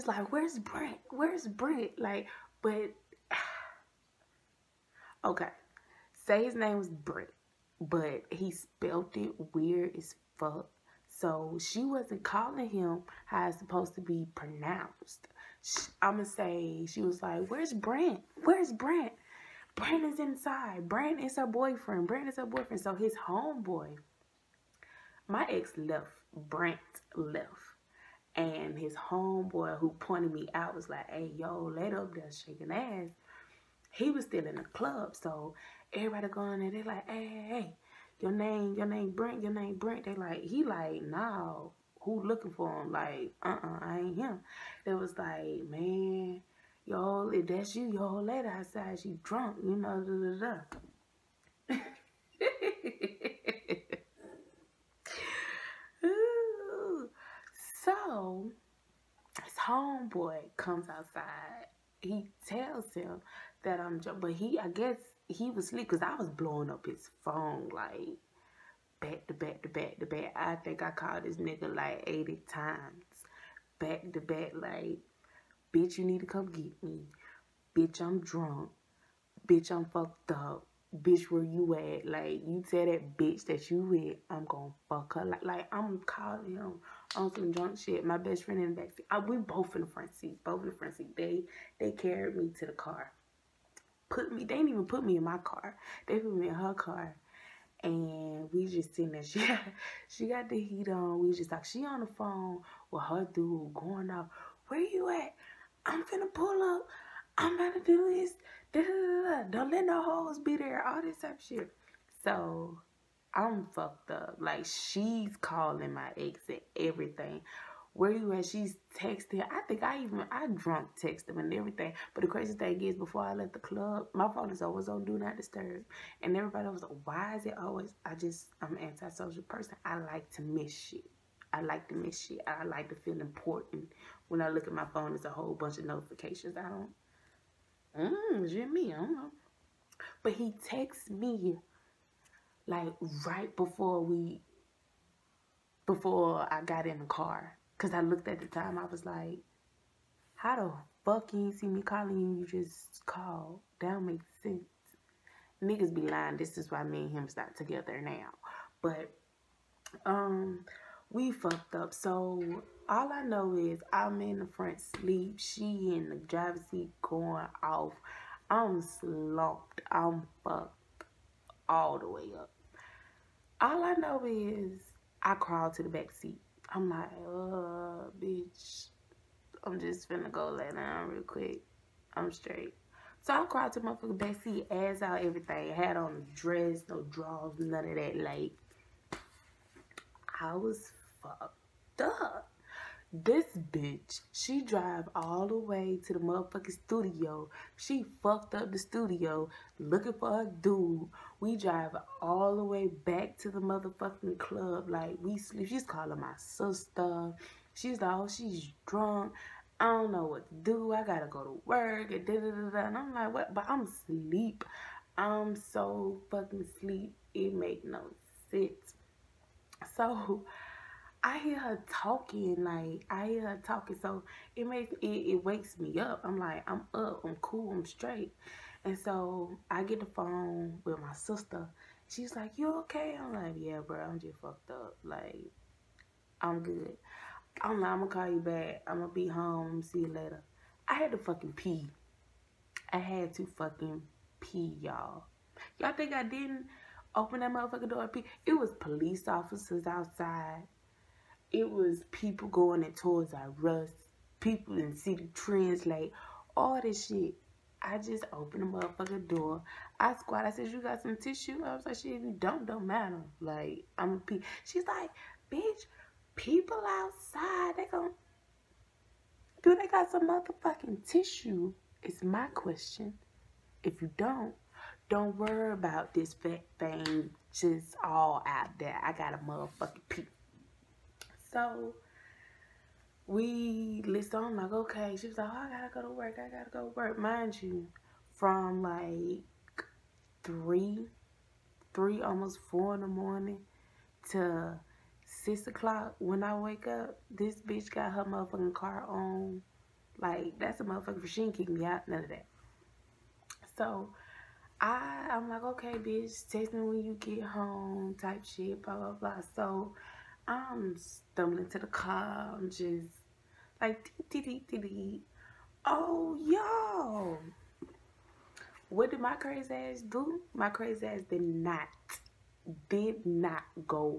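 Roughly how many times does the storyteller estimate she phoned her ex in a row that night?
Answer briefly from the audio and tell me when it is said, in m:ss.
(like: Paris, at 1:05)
80, at 1:11.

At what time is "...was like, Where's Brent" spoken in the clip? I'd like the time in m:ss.
0:17.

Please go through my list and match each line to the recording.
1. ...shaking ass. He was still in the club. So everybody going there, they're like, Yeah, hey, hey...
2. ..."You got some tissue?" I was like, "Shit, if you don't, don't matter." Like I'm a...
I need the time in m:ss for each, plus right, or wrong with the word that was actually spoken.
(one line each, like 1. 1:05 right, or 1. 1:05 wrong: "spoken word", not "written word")
1. 0:32 wrong: "Hey", not "Yeah"
2. 4:20 right.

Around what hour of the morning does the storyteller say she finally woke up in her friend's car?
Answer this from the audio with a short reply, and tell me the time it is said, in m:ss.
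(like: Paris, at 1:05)
6, at 4:55.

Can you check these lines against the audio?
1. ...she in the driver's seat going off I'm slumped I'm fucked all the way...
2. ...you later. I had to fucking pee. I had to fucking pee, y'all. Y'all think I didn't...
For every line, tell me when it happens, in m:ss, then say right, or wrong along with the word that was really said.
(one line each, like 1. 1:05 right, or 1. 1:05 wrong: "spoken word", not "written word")
1. 2:45 right
2. 3:59 right.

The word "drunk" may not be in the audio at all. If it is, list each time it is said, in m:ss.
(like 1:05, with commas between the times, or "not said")
0:49, 1:18, 1:27, 2:00, 3:28.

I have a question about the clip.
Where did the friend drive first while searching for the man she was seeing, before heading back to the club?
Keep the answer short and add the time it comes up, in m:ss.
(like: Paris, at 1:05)
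The studio, at 3:16.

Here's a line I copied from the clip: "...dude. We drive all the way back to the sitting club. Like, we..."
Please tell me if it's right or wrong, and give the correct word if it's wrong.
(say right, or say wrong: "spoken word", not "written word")
wrong: "motherfucking", not "sitting".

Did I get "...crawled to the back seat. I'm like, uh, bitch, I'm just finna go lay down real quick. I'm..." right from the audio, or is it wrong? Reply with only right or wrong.
right.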